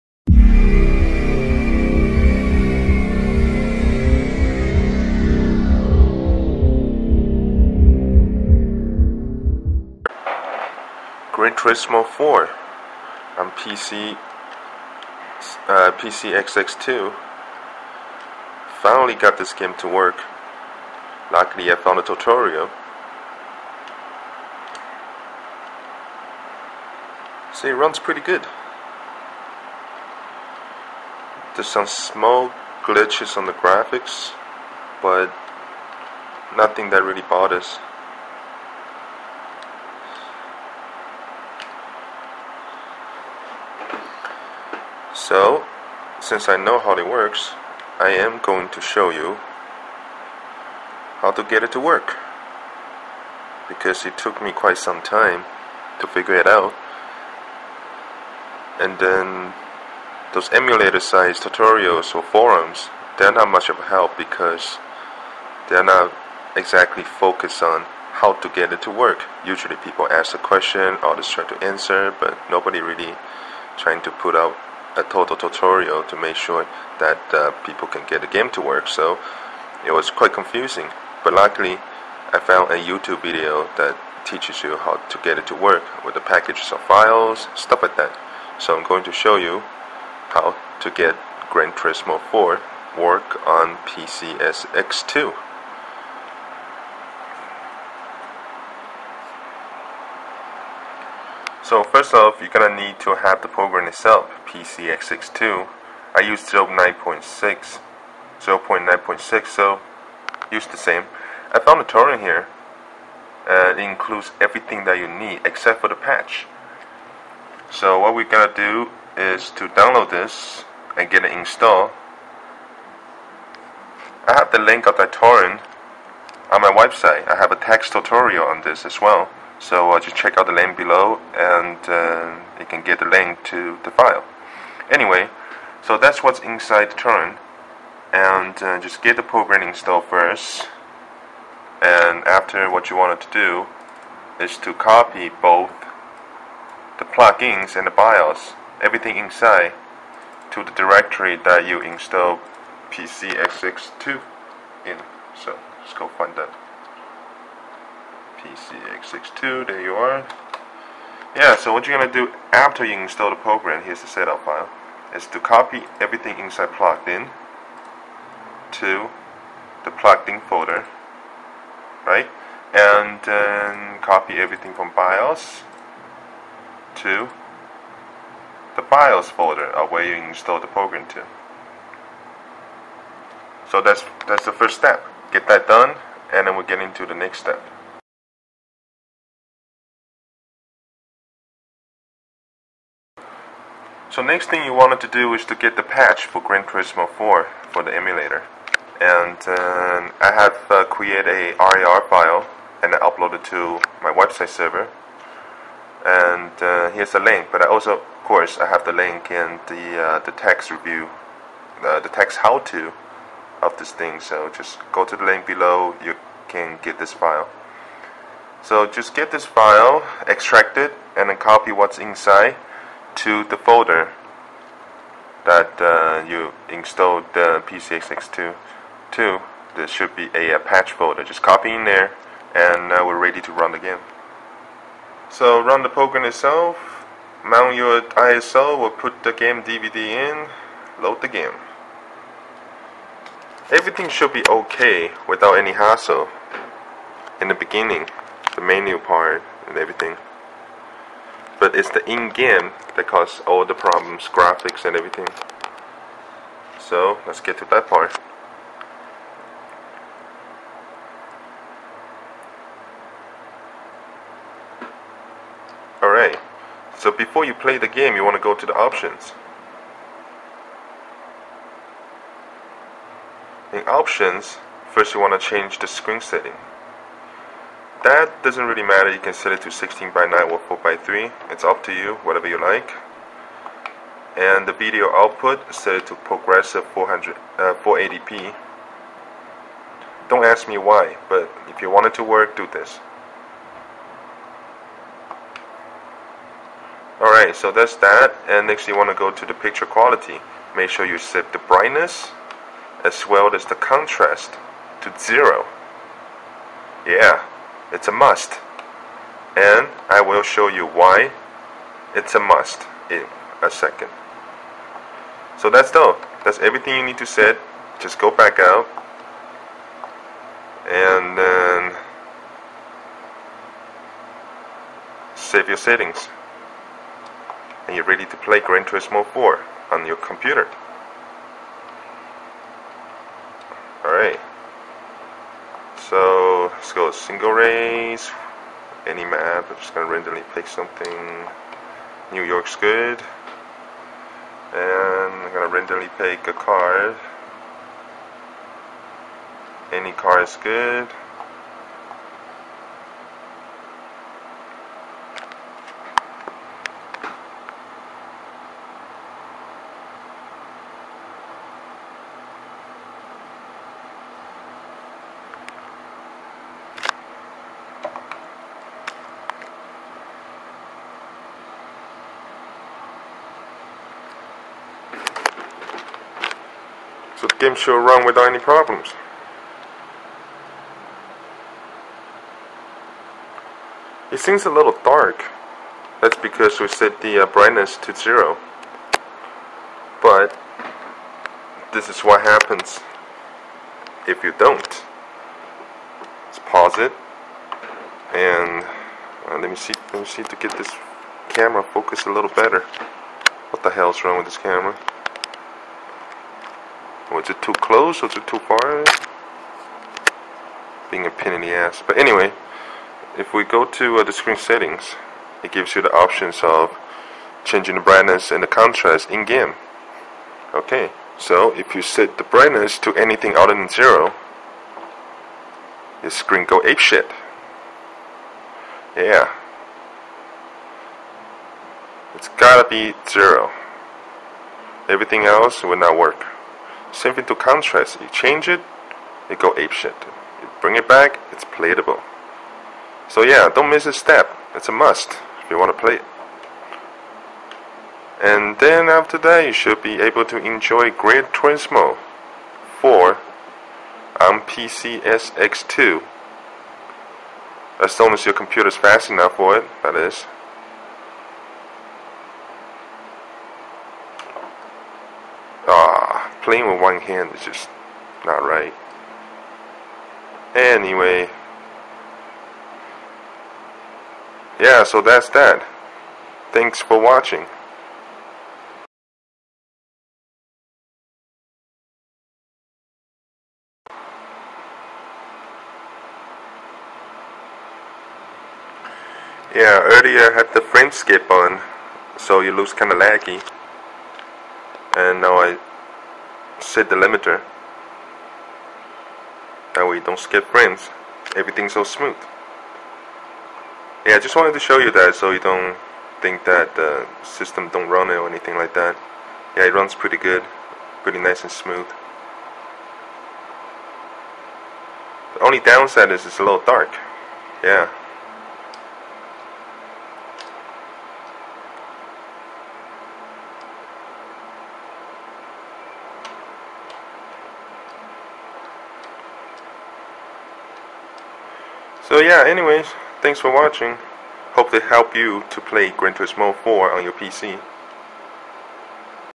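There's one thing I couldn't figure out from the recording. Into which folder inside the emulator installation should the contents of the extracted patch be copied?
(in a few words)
patch folder.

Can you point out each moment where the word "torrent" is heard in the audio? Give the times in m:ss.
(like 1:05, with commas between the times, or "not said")
1:51, 2:05.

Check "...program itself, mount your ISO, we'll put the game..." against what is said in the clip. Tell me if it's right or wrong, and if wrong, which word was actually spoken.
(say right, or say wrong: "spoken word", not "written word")
right.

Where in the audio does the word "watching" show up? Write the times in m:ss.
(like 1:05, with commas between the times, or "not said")
7:57, 8:53.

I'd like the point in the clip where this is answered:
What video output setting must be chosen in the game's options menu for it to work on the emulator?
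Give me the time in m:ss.
4:47.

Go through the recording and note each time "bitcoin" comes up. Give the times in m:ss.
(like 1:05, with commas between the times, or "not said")
not said.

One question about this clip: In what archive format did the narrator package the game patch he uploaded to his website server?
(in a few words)
RAR.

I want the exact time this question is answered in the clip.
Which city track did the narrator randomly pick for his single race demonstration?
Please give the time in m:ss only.
5:42.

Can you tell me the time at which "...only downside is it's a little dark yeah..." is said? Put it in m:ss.
8:35.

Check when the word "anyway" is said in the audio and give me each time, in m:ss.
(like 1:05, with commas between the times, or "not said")
2:14, 6:52, 7:50, 8:52.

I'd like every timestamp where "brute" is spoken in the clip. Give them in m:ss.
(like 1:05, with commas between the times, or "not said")
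not said.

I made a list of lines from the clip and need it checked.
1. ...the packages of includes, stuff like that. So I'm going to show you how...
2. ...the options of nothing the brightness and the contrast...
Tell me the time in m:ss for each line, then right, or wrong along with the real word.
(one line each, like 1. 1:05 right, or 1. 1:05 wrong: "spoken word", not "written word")
1. 1:26 wrong: "files", not "includes"
2. 6:56 wrong: "changing", not "nothing".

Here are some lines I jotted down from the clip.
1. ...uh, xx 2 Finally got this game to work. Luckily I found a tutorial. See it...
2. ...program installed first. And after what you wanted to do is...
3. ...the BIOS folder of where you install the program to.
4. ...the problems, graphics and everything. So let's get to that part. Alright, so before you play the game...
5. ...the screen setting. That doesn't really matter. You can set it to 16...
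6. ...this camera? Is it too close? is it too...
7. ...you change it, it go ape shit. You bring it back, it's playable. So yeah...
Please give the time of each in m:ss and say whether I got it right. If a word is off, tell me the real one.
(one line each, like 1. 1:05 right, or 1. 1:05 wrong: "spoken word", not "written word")
1. 0:15 right
2. 2:19 right
3. 2:58 right
4. 4:13 right
5. 4:35 right
6. 6:44 right
7. 7:18 right.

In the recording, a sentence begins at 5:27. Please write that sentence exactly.
And you're ready to play Gran Turismo 4 on your computer.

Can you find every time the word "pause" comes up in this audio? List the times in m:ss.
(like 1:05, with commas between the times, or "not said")
6:36.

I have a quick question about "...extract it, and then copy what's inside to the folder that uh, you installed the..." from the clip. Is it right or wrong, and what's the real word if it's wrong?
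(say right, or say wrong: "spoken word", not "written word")
right.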